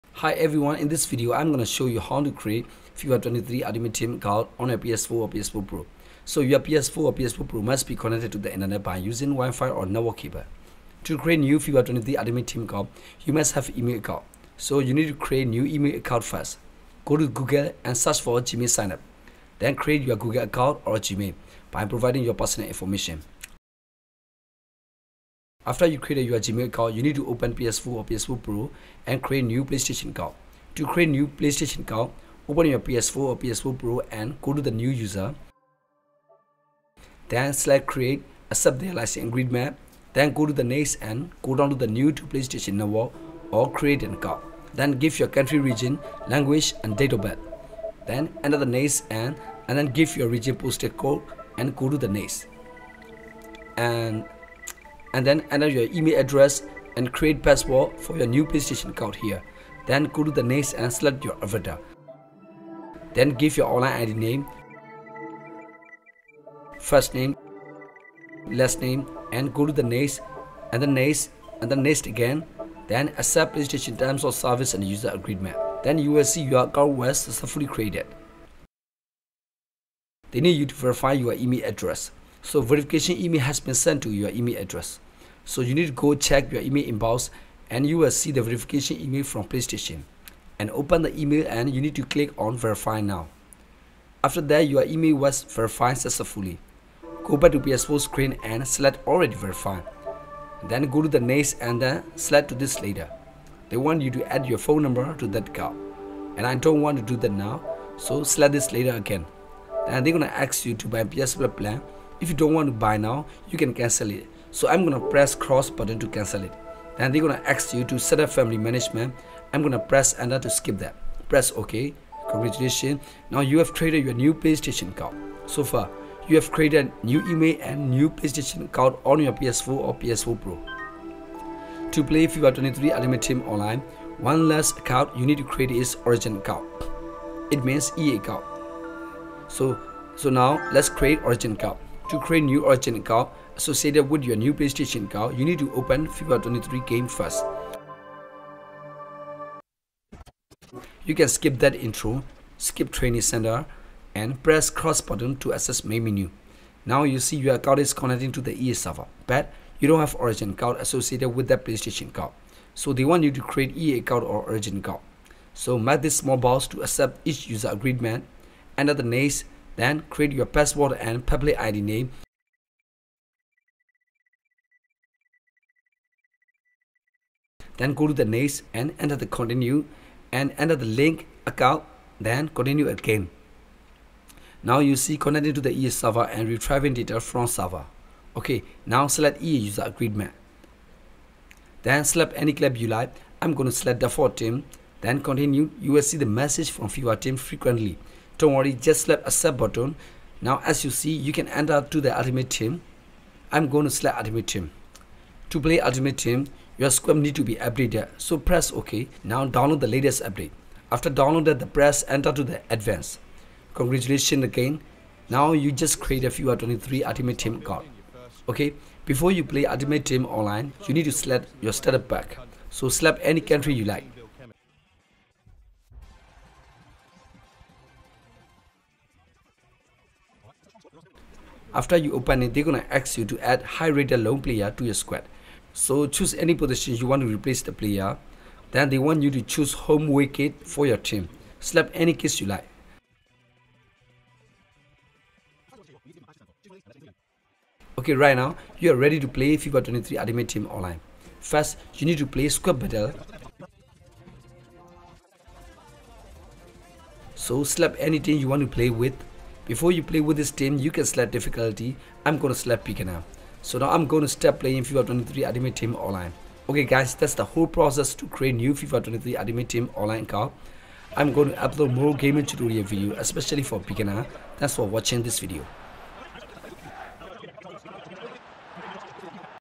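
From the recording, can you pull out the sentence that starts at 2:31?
You can skip that intro, skip training center, and press cross button to access main menu.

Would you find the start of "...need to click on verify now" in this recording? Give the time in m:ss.
1:31.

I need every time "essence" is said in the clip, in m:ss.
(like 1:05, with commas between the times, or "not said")
not said.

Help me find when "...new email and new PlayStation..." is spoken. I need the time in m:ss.
2:07.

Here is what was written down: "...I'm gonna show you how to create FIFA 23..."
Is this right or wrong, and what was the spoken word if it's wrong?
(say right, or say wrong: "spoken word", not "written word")
right.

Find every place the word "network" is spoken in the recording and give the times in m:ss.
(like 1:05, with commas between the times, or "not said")
0:09, 0:42.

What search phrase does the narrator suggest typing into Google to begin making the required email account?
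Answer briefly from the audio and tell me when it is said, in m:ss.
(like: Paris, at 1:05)
Gmail sign up, at 0:18.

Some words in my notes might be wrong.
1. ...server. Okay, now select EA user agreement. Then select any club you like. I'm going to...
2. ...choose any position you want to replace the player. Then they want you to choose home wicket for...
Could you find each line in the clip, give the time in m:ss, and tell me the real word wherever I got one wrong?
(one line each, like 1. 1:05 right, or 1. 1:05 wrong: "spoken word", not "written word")
1. 3:07 right
2. 3:56 right.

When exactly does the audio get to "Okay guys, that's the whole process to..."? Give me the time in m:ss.
4:26.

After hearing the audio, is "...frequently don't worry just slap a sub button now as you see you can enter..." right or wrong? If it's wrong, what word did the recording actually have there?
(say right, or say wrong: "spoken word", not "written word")
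right.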